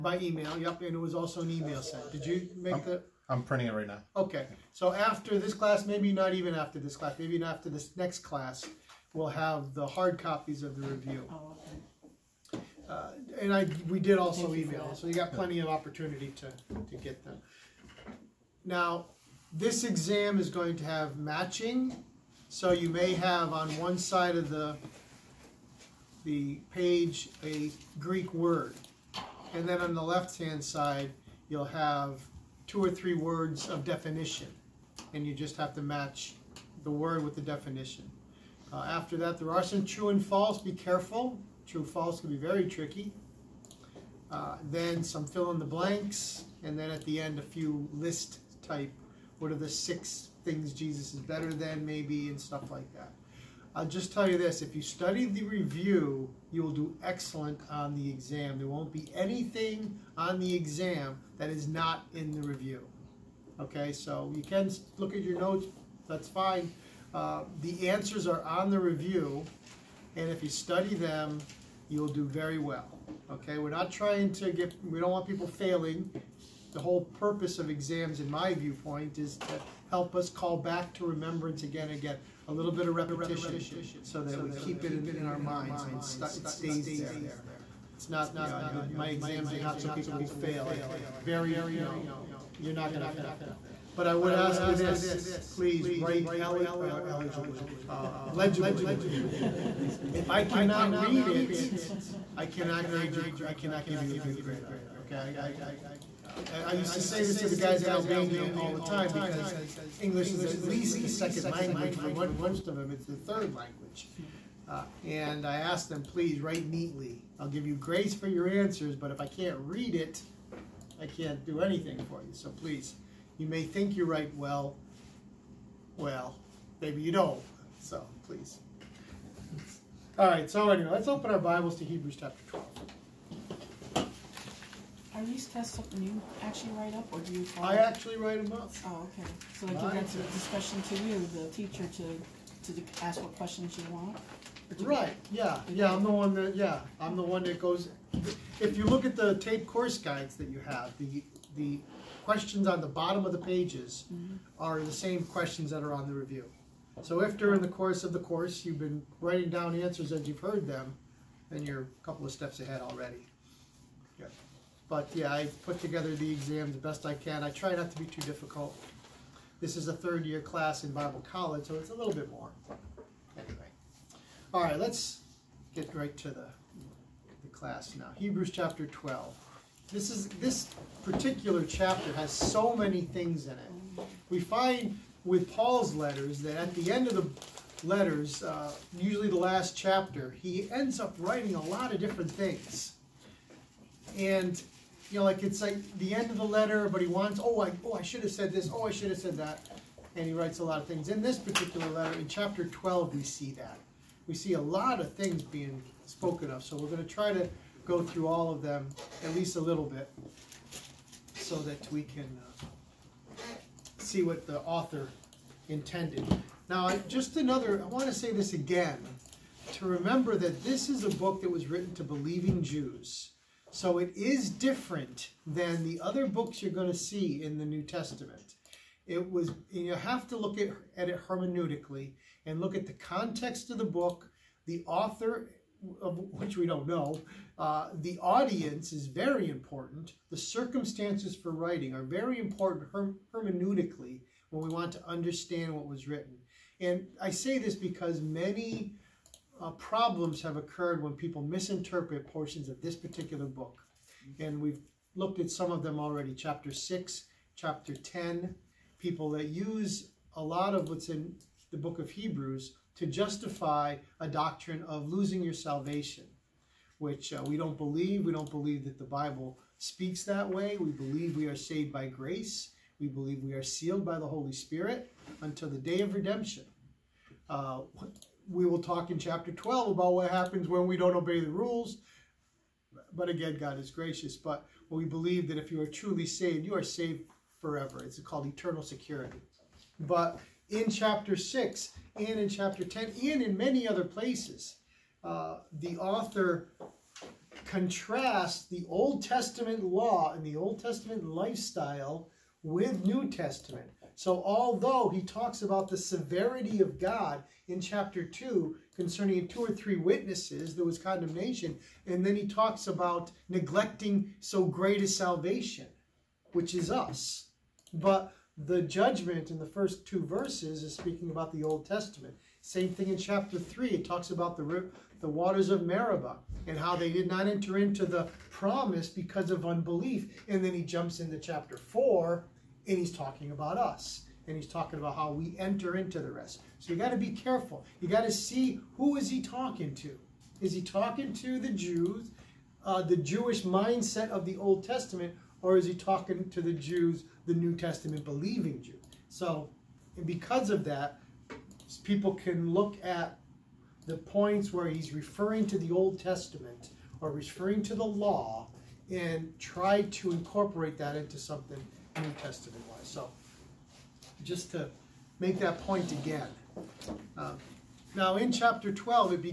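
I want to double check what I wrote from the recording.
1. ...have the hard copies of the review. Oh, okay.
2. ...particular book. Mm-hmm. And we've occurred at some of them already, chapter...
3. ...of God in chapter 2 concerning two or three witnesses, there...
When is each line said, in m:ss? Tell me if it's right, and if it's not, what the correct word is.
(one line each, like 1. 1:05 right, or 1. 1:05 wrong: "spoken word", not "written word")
1. 0:09 right
2. 4:12 wrong: "looked", not "occurred"
3. 5:06 right.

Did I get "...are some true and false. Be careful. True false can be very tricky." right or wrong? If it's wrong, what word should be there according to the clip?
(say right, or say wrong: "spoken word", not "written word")
right.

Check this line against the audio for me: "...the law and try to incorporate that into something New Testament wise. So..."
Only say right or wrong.
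right.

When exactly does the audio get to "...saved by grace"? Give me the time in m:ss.
4:31.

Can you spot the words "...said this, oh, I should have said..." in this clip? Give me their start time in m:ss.
3:18.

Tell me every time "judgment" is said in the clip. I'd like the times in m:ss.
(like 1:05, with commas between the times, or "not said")
5:18.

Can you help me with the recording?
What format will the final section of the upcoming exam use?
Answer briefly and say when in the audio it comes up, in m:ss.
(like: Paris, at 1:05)
list type, at 0:47.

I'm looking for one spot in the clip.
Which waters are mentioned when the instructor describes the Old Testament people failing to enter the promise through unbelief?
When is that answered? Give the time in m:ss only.
5:25.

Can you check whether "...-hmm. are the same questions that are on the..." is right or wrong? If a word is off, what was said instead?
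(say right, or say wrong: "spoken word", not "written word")
right.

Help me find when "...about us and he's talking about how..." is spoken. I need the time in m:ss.
5:33.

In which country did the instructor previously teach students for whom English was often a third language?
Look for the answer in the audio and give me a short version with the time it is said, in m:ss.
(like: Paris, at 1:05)
Albania, at 1:47.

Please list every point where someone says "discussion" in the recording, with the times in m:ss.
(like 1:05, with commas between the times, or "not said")
2:20.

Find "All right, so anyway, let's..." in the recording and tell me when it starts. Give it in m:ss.
2:10.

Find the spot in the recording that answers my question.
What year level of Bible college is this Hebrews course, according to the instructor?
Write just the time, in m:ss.
2:49.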